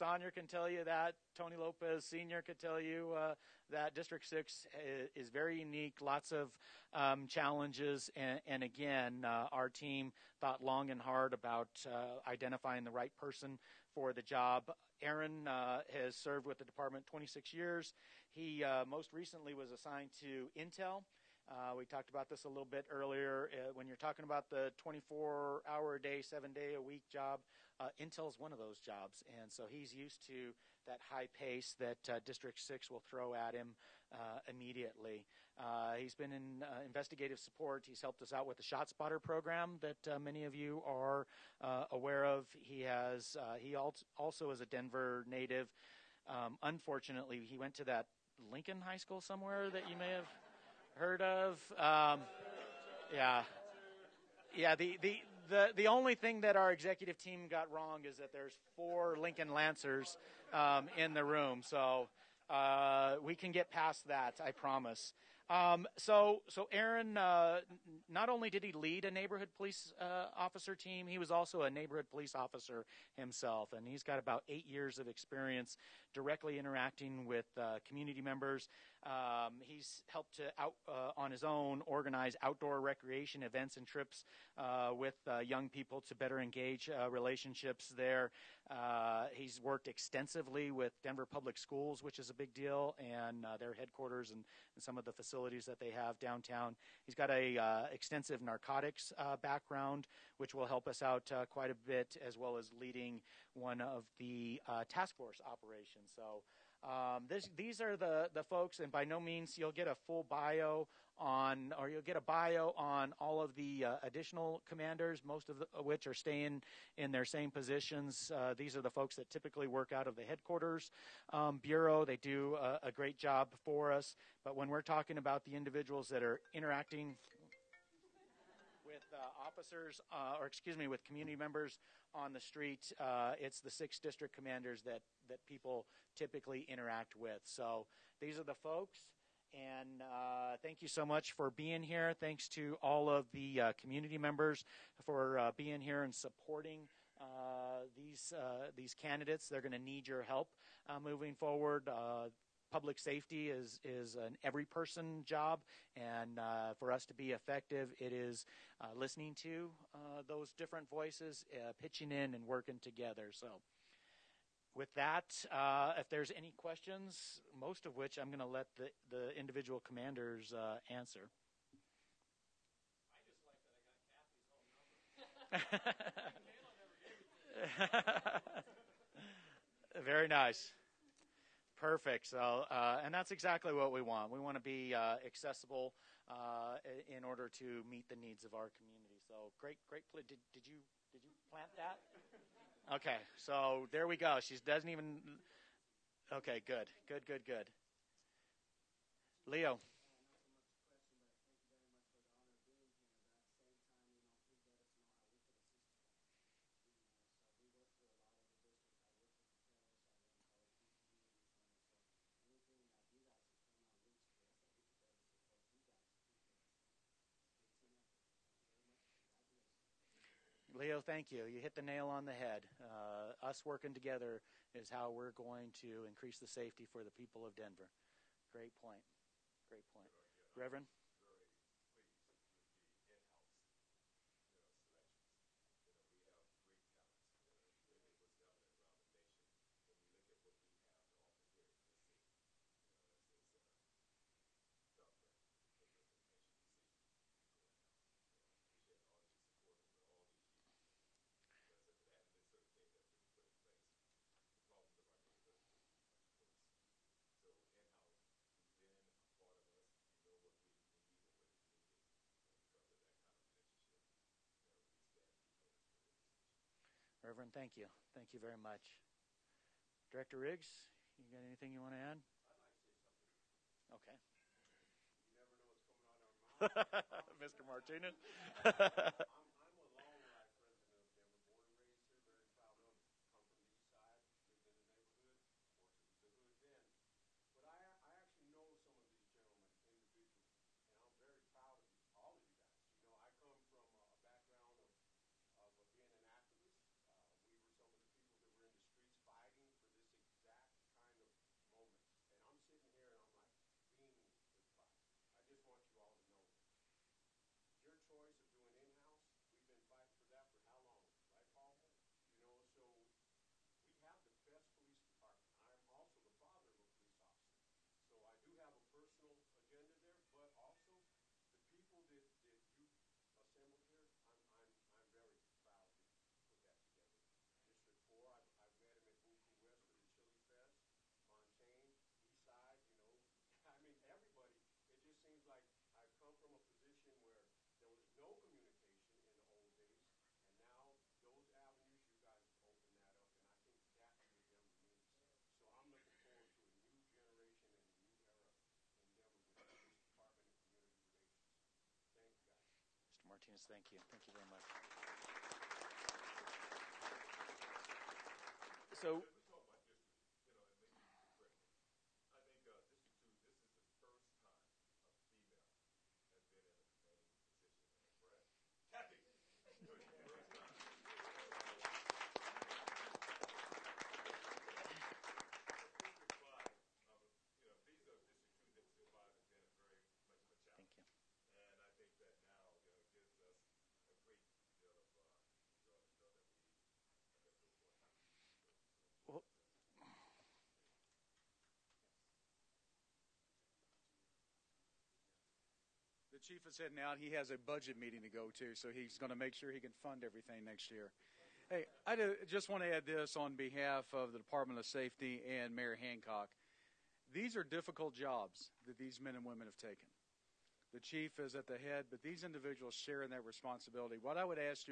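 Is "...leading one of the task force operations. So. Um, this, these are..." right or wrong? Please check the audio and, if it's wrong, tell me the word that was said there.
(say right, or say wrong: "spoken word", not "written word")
right.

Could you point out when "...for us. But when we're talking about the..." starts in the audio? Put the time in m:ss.
2:03.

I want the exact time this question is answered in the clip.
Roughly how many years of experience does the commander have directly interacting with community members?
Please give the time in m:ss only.
1:14.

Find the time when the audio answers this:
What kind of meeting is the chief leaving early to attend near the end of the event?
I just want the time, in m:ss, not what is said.
6:37.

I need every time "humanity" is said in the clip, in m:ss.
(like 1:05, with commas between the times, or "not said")
not said.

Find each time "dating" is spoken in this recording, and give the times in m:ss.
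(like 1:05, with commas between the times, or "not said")
not said.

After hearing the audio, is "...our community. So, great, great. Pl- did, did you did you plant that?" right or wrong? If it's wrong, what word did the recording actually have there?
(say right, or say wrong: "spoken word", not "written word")
right.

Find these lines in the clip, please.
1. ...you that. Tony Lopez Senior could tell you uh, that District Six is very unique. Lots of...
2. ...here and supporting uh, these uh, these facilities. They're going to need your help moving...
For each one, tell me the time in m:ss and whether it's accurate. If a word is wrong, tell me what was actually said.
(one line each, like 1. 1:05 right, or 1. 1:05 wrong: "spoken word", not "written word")
1. 0:00 right
2. 2:25 wrong: "candidates", not "facilities".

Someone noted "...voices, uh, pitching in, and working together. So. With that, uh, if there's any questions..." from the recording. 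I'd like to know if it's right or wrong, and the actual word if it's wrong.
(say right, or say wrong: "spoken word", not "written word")
right.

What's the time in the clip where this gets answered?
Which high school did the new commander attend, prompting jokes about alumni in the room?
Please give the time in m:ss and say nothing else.
0:48.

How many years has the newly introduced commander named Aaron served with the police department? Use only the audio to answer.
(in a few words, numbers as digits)
26.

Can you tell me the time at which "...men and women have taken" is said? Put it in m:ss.
6:49.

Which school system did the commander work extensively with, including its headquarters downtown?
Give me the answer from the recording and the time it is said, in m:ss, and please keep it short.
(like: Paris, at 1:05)
Denver Public Schools, at 1:31.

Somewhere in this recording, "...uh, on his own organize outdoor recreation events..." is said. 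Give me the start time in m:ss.
1:20.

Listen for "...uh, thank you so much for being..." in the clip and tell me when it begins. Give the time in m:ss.
2:20.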